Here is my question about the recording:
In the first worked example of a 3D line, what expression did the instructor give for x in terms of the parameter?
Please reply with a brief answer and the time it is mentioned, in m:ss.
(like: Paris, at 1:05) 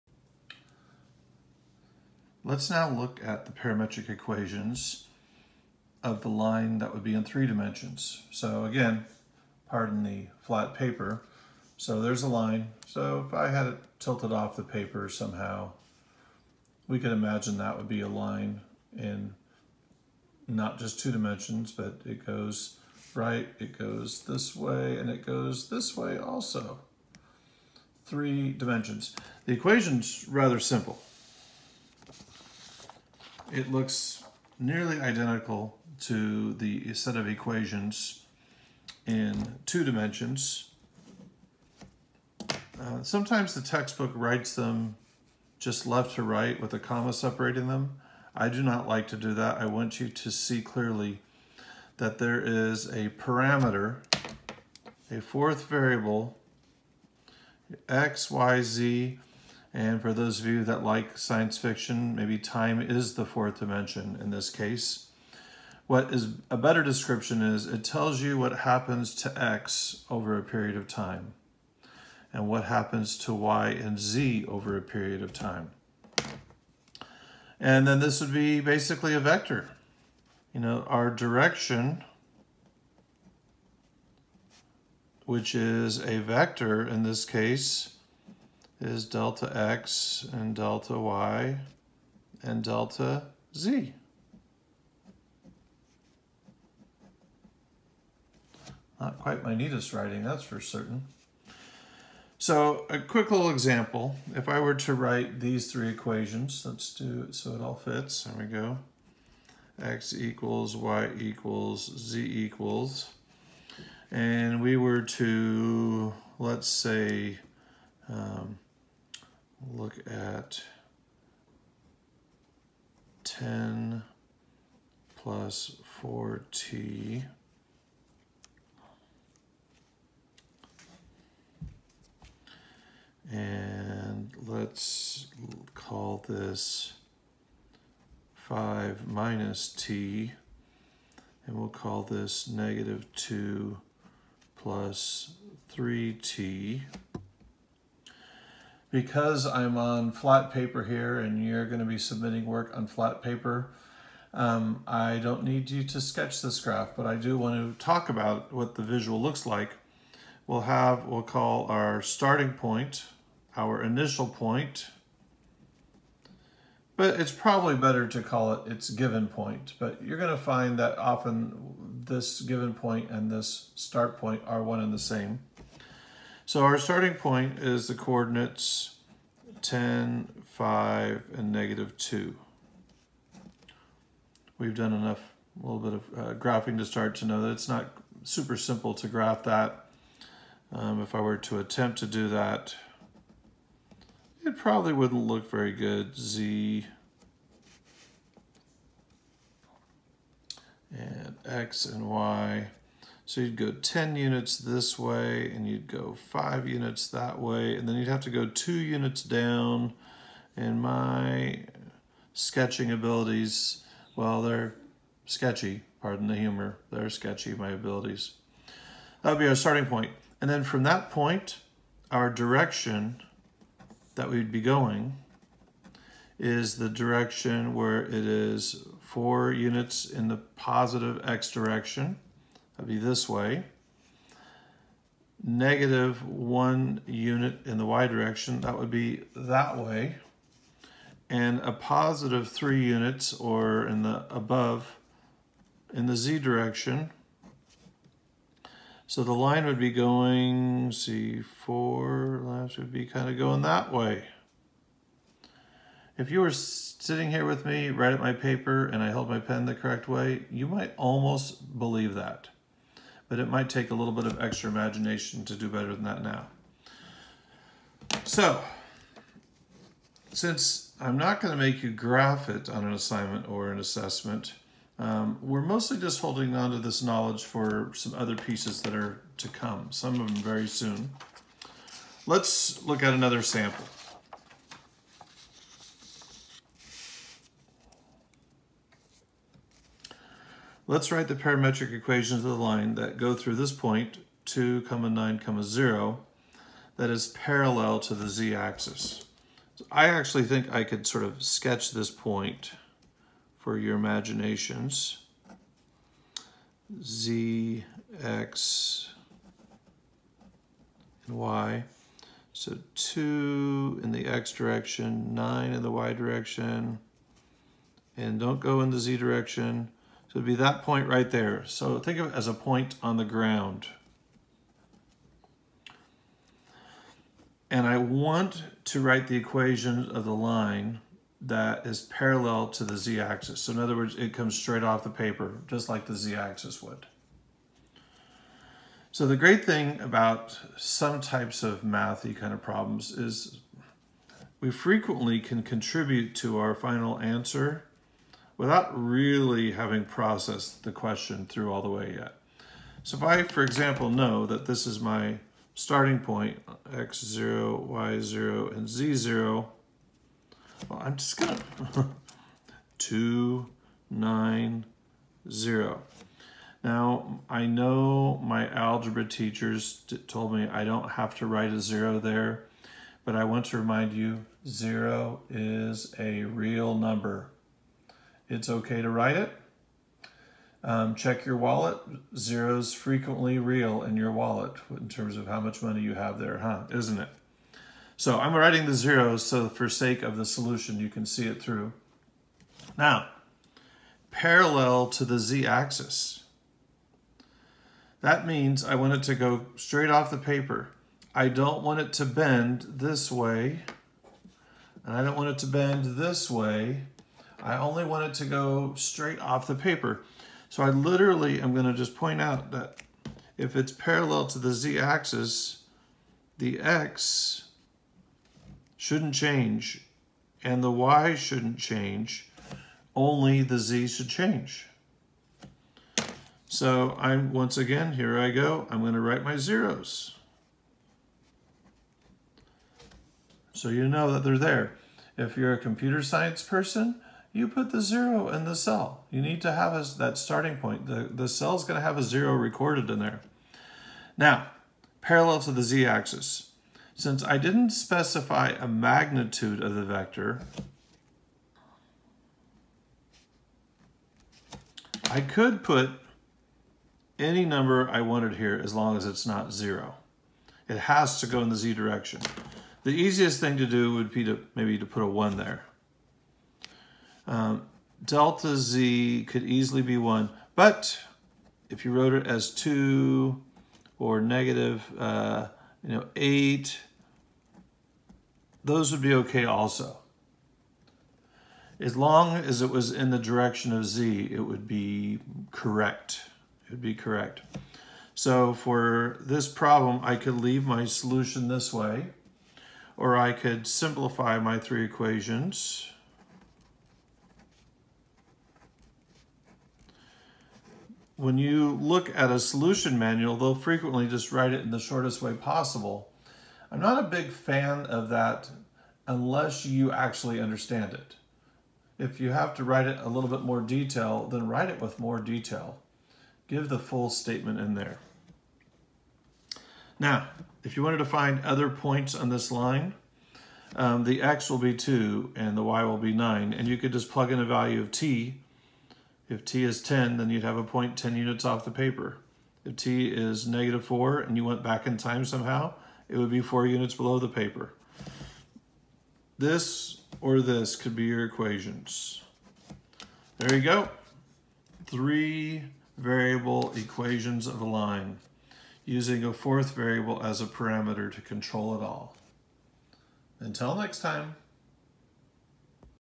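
10 + 4t, at 2:03.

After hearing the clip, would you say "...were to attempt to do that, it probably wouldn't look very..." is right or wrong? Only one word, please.
right.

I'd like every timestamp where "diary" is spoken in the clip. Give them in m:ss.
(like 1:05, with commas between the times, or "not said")
not said.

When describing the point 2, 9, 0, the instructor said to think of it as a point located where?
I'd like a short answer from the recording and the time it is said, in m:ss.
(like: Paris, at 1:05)
on the ground, at 5:23.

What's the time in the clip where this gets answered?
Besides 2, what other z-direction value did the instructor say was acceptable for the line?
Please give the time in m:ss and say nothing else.
7:54.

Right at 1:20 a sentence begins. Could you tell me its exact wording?
You know, our direction, which is a vector in this case, is delta x and delta y and delta z.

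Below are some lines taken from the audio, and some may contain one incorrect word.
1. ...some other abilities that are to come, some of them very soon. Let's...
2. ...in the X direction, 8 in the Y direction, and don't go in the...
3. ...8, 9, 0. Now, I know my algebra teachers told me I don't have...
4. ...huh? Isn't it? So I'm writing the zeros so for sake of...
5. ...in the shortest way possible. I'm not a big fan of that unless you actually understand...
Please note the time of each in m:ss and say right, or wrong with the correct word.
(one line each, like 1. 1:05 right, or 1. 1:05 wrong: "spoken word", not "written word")
1. 4:37 wrong: "pieces", not "abilities"
2. 5:14 wrong: "9", not "8"
3. 6:02 wrong: "2", not "8"
4. 6:26 right
5. 8:24 right.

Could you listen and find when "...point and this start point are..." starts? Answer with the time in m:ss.
2:52.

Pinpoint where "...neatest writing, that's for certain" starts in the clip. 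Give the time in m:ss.
1:39.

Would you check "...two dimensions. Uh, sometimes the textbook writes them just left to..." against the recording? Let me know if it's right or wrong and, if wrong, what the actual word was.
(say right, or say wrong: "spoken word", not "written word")
right.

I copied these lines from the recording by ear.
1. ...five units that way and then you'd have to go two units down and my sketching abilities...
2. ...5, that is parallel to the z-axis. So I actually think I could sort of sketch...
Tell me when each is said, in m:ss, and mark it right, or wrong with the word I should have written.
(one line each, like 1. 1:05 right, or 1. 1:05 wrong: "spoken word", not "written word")
1. 3:26 right
2. 4:55 wrong: "0", not "5".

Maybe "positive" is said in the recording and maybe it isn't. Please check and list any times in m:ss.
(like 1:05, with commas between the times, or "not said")
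3:50, 4:01.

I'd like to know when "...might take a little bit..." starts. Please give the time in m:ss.
4:23.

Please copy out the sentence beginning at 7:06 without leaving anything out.
So I'm once again, here I go, I'm going to write my zeros.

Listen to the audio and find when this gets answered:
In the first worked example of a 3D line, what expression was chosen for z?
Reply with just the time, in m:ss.
2:22.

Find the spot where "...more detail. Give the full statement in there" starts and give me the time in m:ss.
8:35.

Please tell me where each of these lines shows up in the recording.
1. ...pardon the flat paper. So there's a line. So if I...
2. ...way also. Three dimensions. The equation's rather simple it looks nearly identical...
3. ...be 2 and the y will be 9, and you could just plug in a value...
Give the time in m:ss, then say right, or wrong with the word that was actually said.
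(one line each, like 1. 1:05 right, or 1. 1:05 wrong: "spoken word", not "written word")
1. 0:09 right
2. 0:25 right
3. 8:44 right.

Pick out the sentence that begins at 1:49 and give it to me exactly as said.
X equals, Y equals, Z equals.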